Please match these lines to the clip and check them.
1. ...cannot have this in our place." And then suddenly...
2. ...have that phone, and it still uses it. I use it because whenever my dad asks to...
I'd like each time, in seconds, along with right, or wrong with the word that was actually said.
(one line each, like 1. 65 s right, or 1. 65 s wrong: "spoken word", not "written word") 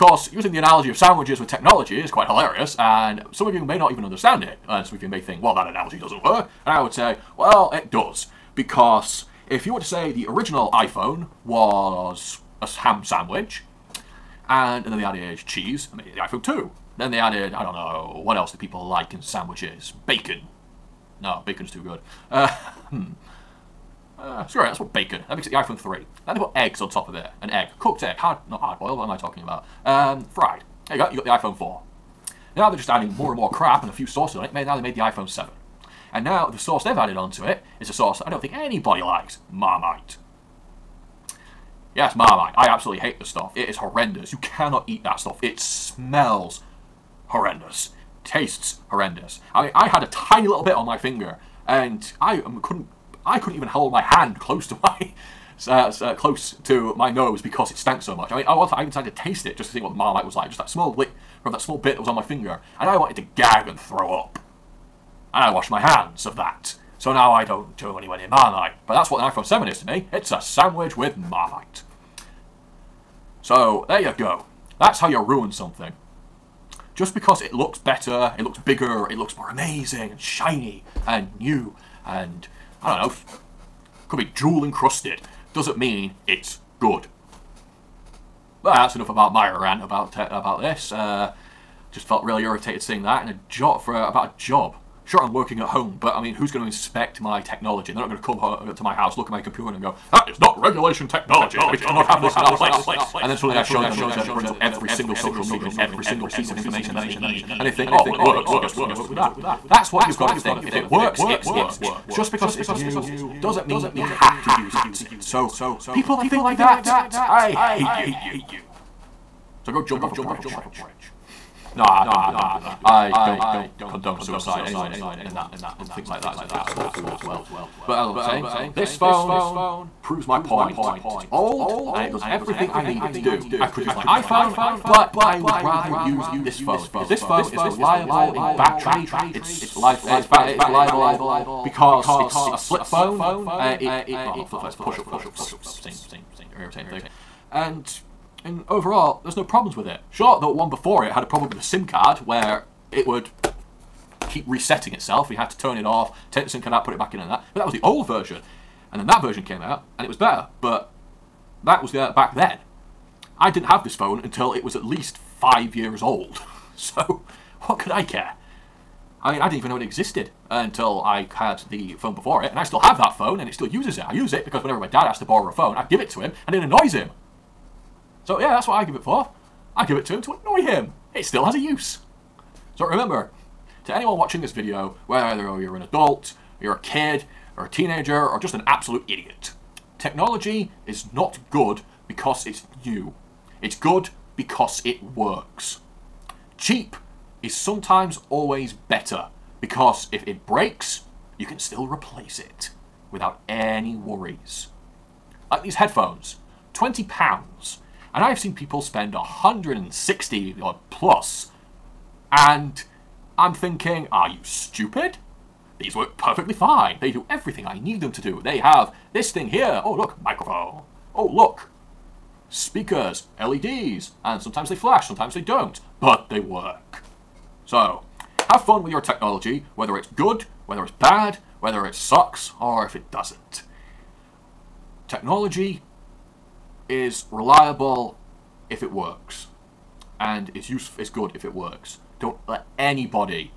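1. 101 s right
2. 172 s right.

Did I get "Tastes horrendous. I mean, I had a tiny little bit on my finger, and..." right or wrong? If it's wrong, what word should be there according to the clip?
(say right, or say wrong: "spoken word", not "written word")
right.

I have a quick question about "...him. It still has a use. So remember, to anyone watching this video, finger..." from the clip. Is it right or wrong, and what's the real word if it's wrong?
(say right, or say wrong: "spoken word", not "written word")
wrong: "whether", not "finger".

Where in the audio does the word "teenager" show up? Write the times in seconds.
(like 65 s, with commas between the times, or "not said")
187 s.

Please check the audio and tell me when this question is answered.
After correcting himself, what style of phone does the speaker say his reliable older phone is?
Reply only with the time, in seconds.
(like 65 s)
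144 s.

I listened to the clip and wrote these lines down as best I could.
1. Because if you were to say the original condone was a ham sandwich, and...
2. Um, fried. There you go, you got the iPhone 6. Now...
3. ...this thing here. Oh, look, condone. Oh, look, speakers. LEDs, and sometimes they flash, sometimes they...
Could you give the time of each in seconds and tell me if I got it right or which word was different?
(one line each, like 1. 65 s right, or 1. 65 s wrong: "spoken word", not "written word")
1. 8 s wrong: "iPhone", not "condone"
2. 29 s wrong: "4", not "6"
3. 219 s wrong: "microphone", not "condone".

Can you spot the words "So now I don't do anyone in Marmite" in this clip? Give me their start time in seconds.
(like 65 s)
66 s.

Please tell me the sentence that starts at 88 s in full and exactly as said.
Well, that's enough about my rant about uh, about this.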